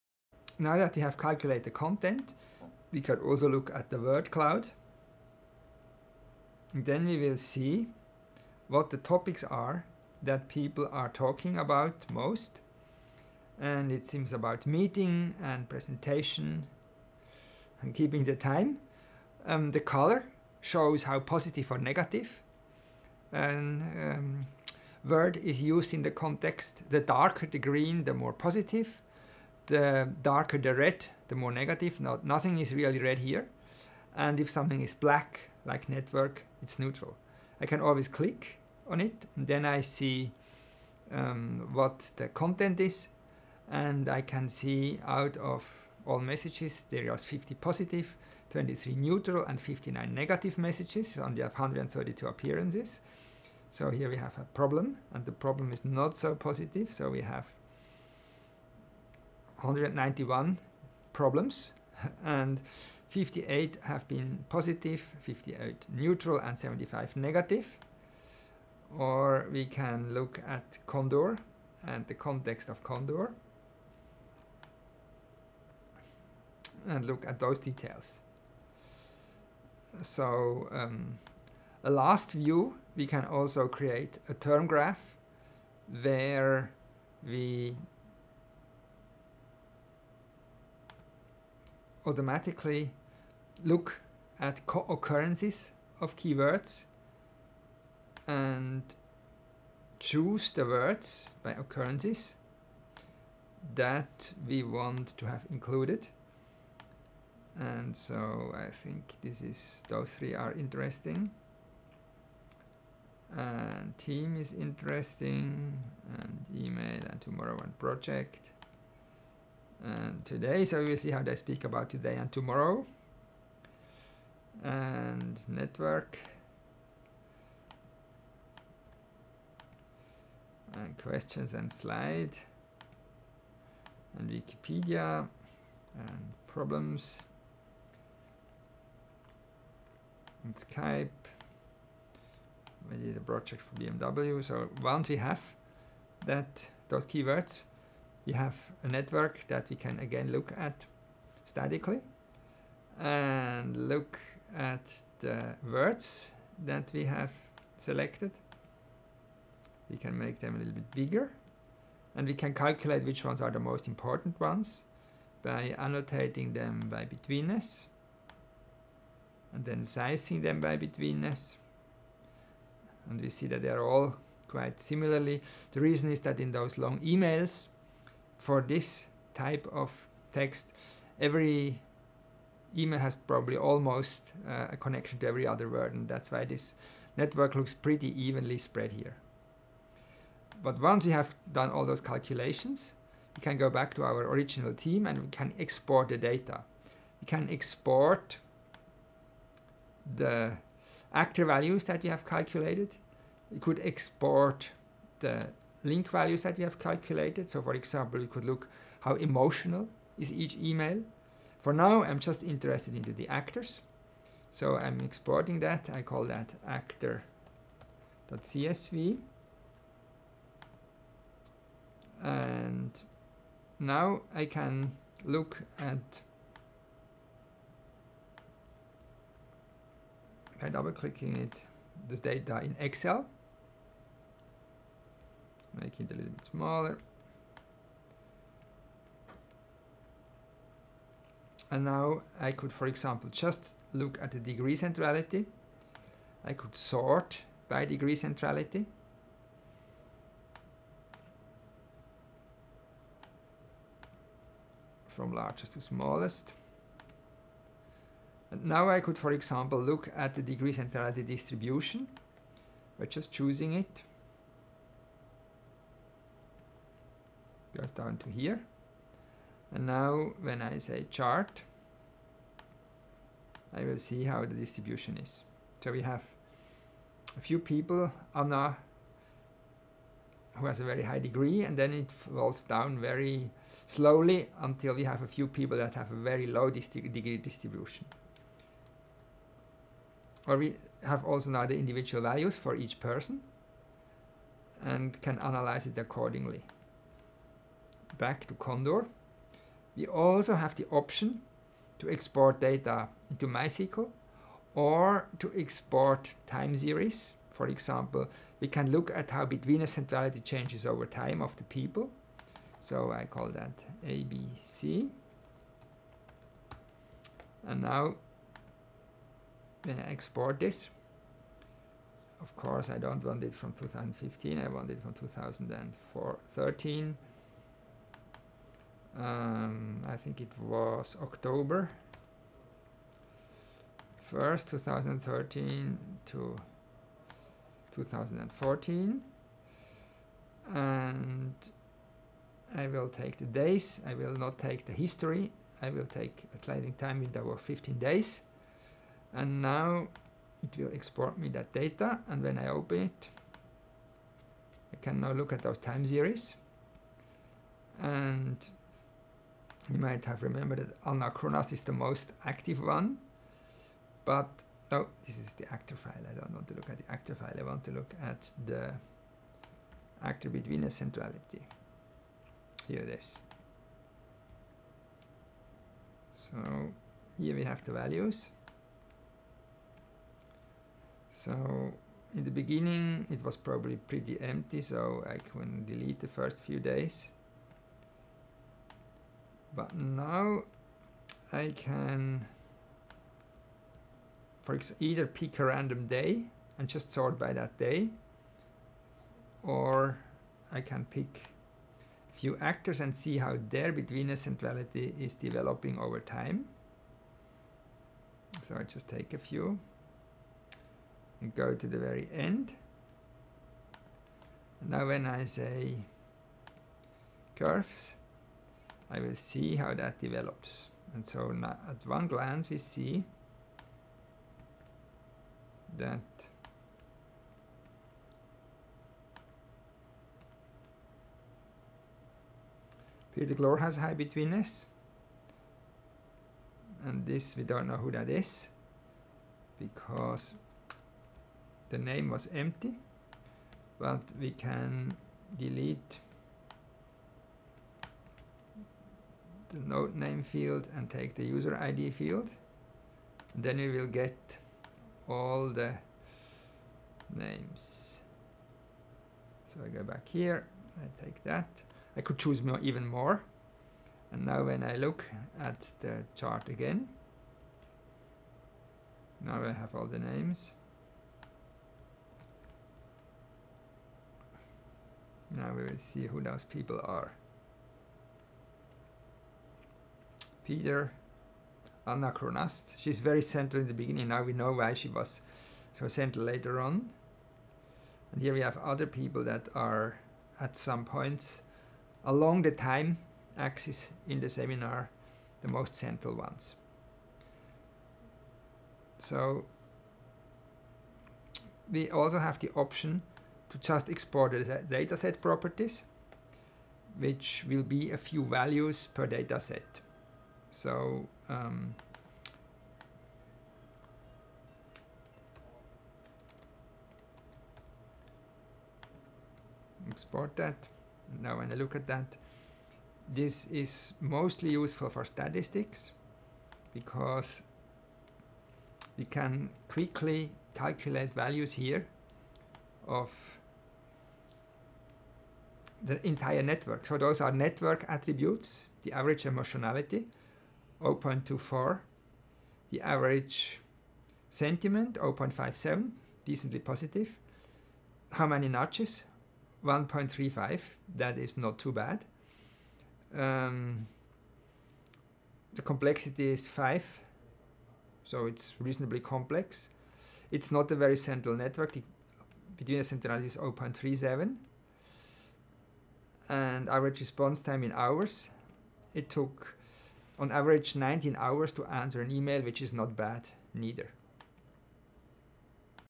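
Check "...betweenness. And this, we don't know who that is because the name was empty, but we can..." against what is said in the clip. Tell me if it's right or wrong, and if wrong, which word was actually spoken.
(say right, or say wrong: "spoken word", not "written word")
right.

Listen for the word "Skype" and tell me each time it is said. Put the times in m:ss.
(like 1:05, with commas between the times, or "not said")
2:20.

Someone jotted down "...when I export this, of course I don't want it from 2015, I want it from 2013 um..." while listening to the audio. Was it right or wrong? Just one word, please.
right.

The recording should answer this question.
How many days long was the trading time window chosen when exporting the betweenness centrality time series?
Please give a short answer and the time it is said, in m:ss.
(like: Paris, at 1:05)
15 days, at 5:47.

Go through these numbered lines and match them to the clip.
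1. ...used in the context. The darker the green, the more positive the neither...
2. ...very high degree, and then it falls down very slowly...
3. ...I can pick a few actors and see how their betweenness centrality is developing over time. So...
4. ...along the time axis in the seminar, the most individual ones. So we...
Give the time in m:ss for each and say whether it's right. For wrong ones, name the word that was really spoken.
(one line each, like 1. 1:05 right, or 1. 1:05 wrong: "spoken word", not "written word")
1. 0:25 wrong: "darker", not "neither"
2. 4:40 right
3. 6:40 right
4. 8:12 wrong: "central", not "individual".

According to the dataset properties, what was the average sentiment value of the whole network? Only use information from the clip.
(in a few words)
0.57.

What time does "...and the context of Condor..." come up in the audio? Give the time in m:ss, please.
1:11.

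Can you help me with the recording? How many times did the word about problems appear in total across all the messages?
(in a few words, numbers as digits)
191.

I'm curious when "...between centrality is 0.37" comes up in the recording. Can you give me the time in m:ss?
9:22.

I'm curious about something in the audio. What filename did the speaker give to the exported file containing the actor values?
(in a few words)
actor.csv.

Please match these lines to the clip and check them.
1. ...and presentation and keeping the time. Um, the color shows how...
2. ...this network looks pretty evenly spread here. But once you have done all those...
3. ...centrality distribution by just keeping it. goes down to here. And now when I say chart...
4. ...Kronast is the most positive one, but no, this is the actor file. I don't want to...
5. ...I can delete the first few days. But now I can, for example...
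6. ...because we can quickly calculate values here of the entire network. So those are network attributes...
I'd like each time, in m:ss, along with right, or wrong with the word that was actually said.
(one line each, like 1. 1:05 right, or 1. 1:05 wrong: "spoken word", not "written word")
1. 0:15 right
2. 3:06 right
3. 4:20 wrong: "choosing", not "keeping"
4. 6:01 wrong: "active", not "positive"
5. 6:25 right
6. 8:46 right.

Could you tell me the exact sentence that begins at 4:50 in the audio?
Or we have also now the individual values for each person and can analyze it accordingly back to Condor.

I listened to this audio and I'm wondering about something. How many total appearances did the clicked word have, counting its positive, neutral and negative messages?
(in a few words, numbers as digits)
132.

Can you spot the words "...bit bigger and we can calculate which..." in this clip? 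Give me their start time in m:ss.
2:40.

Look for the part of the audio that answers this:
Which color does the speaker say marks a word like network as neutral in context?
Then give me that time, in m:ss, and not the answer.
0:34.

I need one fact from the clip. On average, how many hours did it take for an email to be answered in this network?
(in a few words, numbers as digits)
19 hours.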